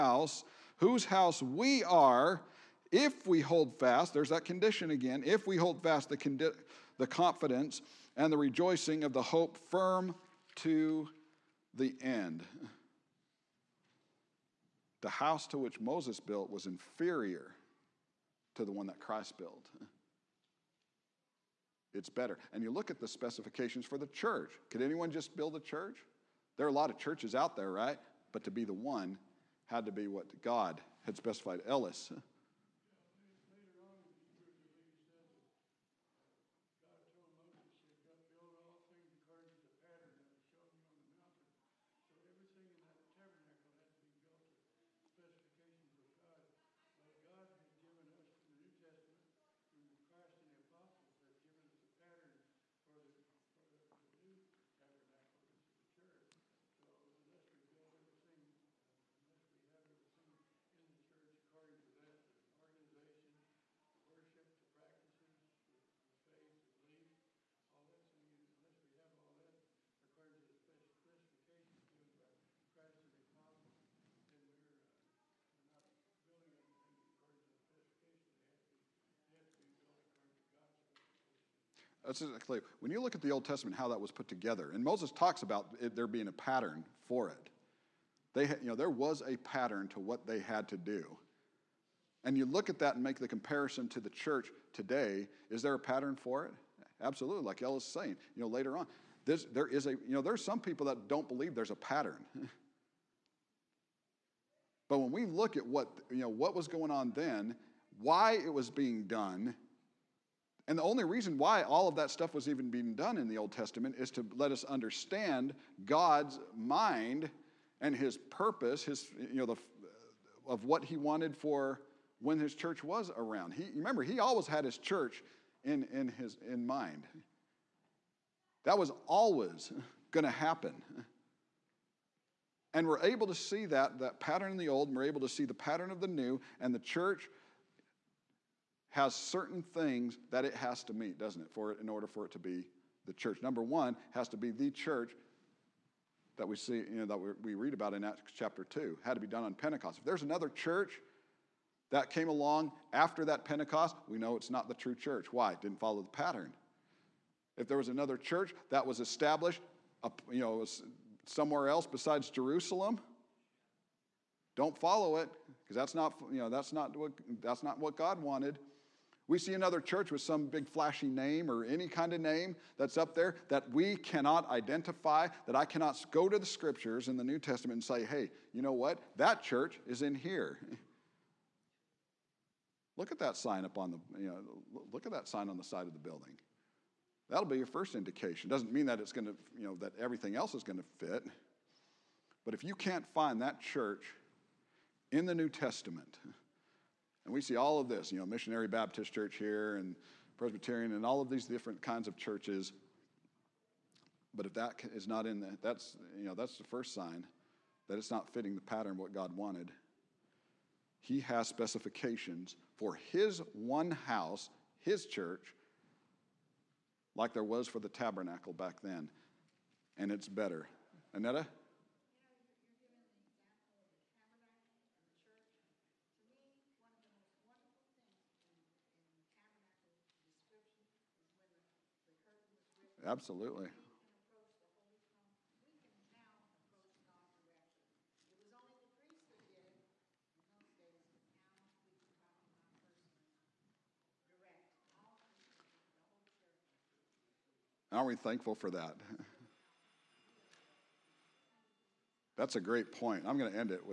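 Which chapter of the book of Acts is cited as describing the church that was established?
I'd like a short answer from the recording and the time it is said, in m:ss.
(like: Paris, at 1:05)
Acts chapter 2, at 2:28.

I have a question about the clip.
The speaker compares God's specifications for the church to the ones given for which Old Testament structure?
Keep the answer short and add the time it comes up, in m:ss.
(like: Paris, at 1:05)
The tabernacle, at 3:37.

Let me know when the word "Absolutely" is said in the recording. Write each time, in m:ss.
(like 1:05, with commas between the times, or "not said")
1:37, 3:53.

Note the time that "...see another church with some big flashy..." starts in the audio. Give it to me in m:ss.
2:49.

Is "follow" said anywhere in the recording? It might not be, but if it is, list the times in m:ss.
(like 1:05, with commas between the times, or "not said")
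2:35, 2:44.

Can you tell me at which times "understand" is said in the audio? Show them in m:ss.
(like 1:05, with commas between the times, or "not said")
1:54.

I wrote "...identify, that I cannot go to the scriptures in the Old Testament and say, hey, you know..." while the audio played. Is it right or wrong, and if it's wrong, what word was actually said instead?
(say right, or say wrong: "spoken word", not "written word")
wrong: "New", not "Old".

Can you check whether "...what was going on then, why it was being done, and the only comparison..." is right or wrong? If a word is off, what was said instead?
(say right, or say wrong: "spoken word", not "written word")
wrong: "reason", not "comparison".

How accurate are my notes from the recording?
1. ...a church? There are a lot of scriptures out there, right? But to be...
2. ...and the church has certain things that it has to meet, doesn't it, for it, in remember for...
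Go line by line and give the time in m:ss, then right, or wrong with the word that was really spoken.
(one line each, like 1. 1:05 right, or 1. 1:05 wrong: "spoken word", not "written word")
1. 0:25 wrong: "churches", not "scriptures"
2. 2:16 wrong: "order", not "remember".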